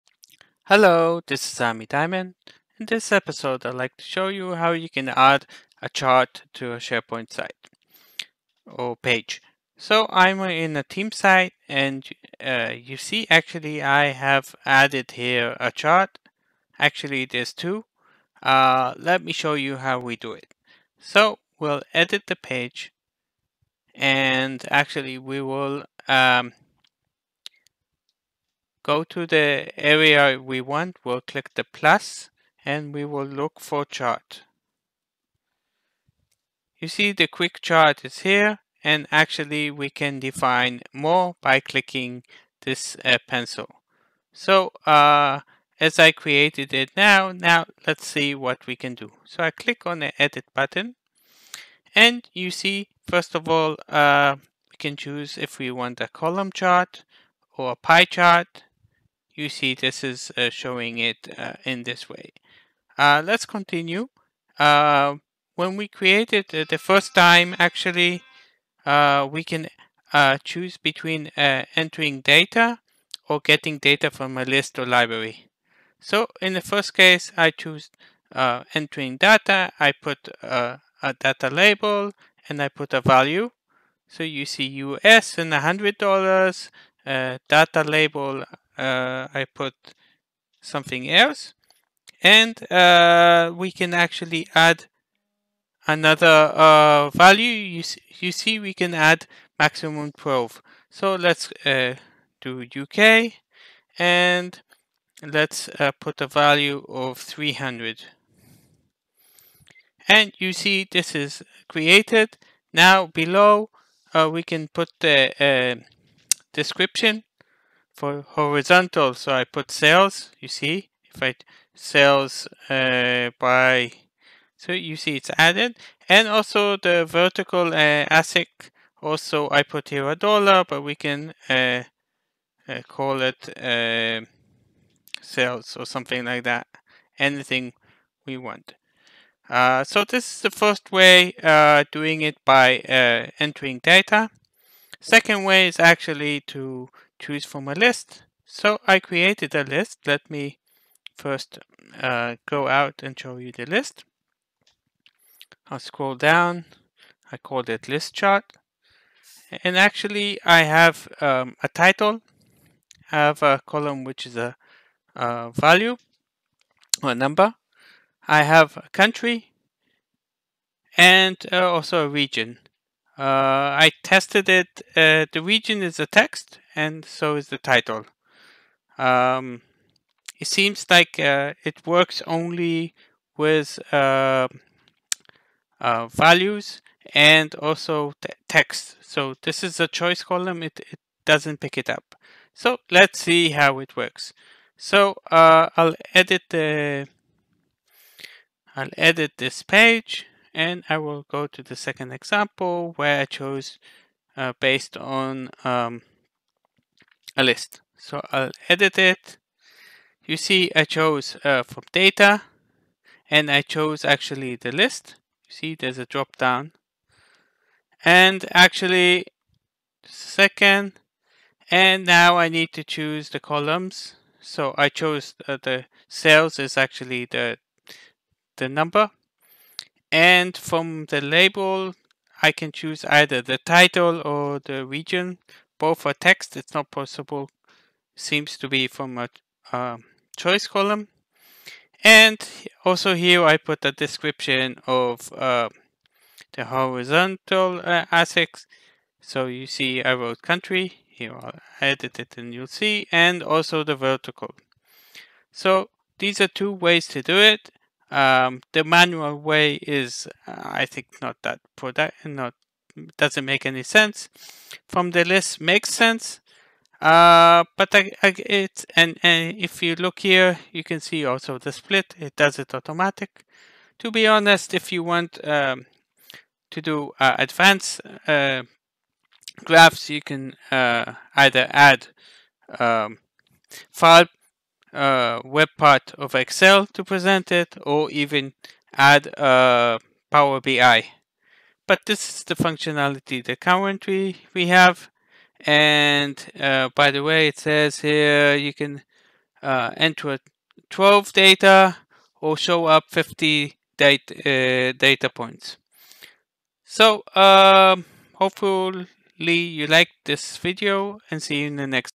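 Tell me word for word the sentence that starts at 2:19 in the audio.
Uh, so this is the first way uh, doing it by entering data.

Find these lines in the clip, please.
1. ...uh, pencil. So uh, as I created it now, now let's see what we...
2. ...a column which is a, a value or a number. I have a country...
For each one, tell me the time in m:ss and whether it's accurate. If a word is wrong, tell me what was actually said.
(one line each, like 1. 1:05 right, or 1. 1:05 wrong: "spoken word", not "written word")
1. 0:43 right
2. 2:43 right.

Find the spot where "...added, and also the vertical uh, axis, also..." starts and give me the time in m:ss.
2:05.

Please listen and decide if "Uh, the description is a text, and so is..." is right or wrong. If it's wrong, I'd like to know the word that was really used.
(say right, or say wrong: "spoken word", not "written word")
wrong: "region", not "description".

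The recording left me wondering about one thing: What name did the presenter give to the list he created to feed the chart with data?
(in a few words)
list chart.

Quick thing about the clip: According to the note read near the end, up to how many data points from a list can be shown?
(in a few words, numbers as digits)
50.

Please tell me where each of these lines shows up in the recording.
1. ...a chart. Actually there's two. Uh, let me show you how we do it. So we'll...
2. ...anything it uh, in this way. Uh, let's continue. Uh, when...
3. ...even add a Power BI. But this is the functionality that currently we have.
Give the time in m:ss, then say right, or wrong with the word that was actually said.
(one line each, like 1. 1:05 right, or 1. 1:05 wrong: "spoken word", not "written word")
1. 0:15 right
2. 1:00 wrong: "showing", not "anything"
3. 4:48 right.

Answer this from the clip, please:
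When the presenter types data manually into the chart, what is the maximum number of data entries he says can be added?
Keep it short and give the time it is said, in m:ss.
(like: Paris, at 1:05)
12, at 1:39.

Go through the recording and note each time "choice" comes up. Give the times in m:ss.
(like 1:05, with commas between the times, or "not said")
3:09, 4:00.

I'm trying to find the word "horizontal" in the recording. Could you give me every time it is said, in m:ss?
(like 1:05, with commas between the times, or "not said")
1:58, 4:06.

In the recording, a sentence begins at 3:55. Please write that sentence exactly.
Both are text, it's not possible.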